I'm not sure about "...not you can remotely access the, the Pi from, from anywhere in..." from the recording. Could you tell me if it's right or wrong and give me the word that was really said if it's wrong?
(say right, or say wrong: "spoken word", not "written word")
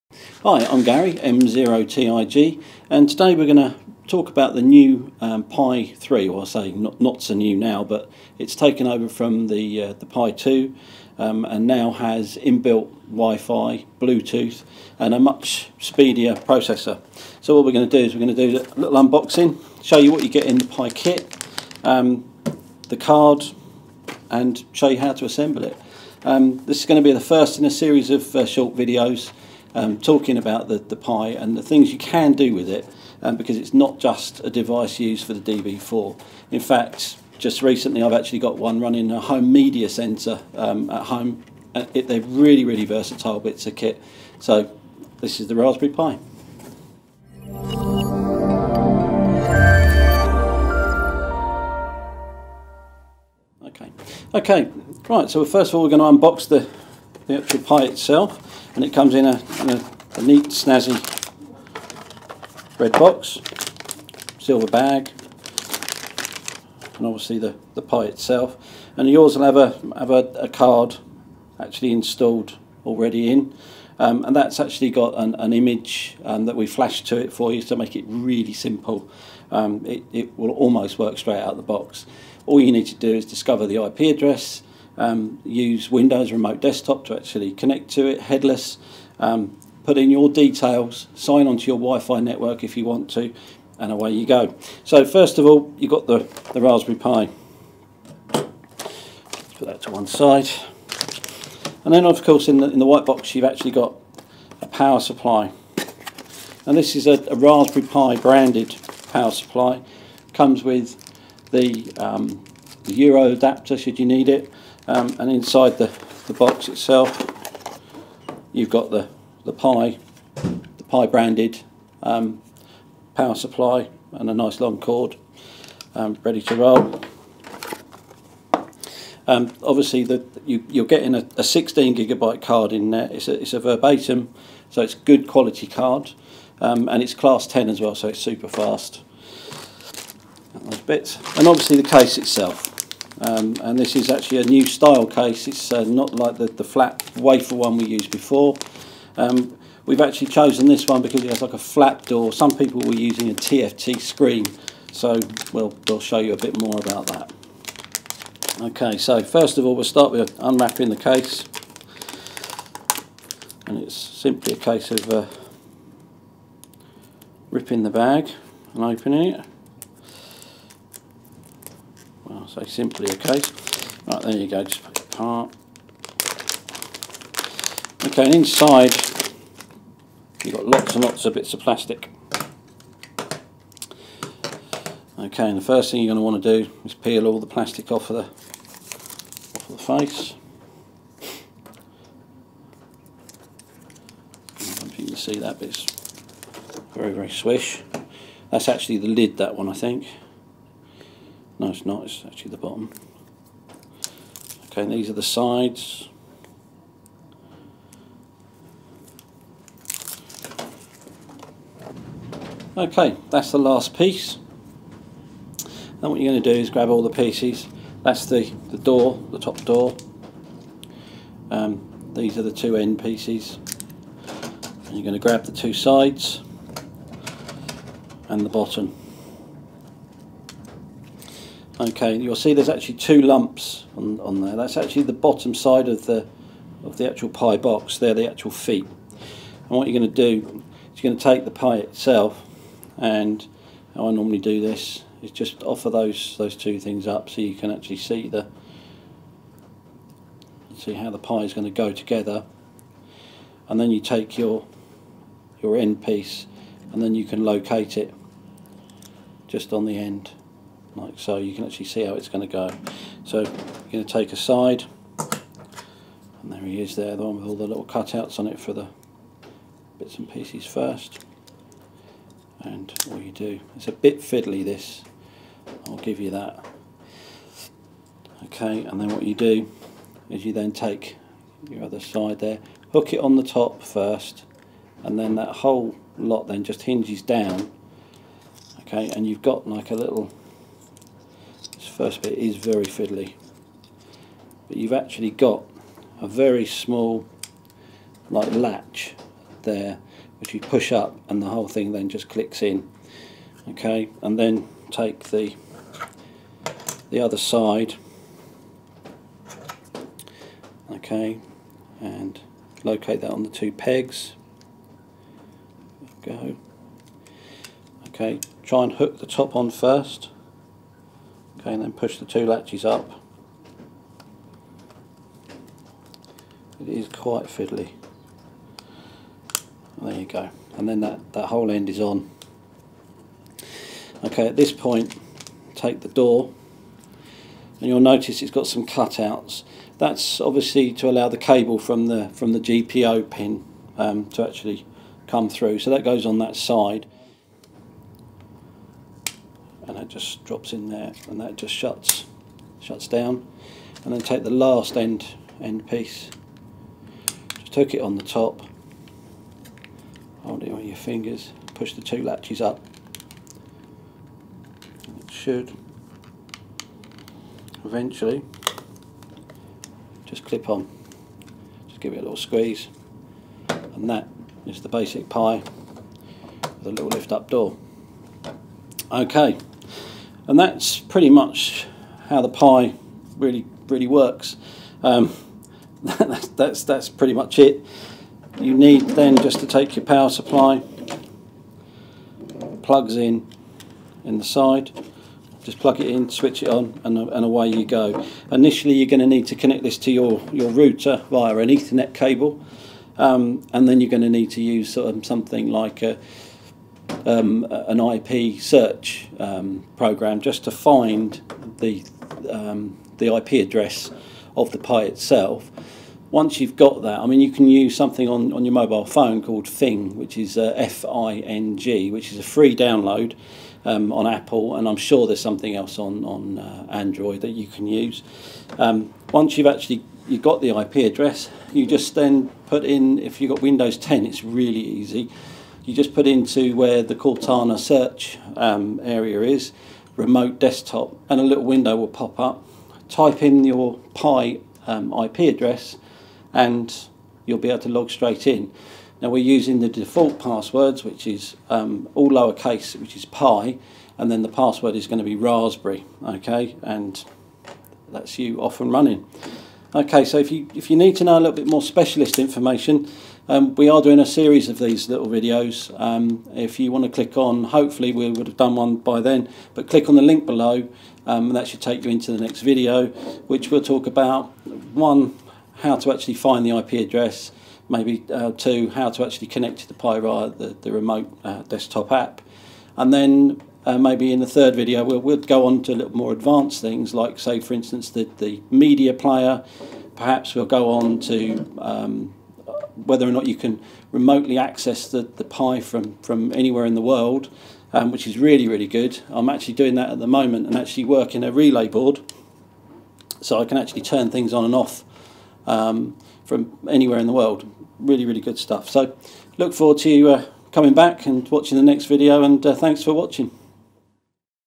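right.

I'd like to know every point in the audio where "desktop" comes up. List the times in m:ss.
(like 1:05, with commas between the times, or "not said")
1:26, 7:20, 8:01.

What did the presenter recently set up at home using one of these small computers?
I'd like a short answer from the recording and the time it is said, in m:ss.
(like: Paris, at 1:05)
A home media center, at 0:39.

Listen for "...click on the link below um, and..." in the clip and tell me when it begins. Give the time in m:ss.
7:49.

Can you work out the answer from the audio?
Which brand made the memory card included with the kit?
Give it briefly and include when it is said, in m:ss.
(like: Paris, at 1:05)
Verbatim, at 2:13.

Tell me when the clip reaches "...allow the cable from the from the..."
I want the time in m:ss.
5:41.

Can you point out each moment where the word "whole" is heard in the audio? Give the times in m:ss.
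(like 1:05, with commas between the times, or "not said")
4:45, 5:01, 5:31.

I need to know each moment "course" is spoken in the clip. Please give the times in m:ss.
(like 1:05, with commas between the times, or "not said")
1:42.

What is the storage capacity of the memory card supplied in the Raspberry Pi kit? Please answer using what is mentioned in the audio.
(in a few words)
16 gigabytes.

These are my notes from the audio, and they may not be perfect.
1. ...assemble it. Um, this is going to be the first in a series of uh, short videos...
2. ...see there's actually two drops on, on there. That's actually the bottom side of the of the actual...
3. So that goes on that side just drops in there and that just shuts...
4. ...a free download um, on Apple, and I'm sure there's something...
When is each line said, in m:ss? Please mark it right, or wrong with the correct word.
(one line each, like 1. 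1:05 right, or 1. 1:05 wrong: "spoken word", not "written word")
1. 0:25 right
2. 3:52 wrong: "lumps", not "drops"
3. 5:45 right
4. 7:02 right.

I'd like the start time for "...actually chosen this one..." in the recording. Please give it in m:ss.
2:30.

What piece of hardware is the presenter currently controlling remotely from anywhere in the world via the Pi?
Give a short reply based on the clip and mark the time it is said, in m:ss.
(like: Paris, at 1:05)
A relay board, at 8:21.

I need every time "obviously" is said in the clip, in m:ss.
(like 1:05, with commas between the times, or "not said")
1:07, 2:09, 2:21, 5:40.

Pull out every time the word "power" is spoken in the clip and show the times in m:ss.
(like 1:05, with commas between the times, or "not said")
1:44, 1:49, 2:03, 6:30.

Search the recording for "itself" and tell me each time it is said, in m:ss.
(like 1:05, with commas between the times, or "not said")
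0:57, 1:08, 1:56, 2:22, 4:01, 6:55.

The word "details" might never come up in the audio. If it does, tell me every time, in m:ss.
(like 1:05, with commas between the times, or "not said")
1:30.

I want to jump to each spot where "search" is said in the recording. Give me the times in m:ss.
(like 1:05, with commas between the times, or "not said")
6:48, 7:17.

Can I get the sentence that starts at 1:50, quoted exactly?
Comes with the, um, the Euro adapter should you need it.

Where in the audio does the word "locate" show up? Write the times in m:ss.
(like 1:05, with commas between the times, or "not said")
4:17, 5:12.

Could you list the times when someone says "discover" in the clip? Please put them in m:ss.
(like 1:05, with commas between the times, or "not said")
1:23.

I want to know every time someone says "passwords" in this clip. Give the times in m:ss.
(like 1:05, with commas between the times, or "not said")
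7:30, 7:34.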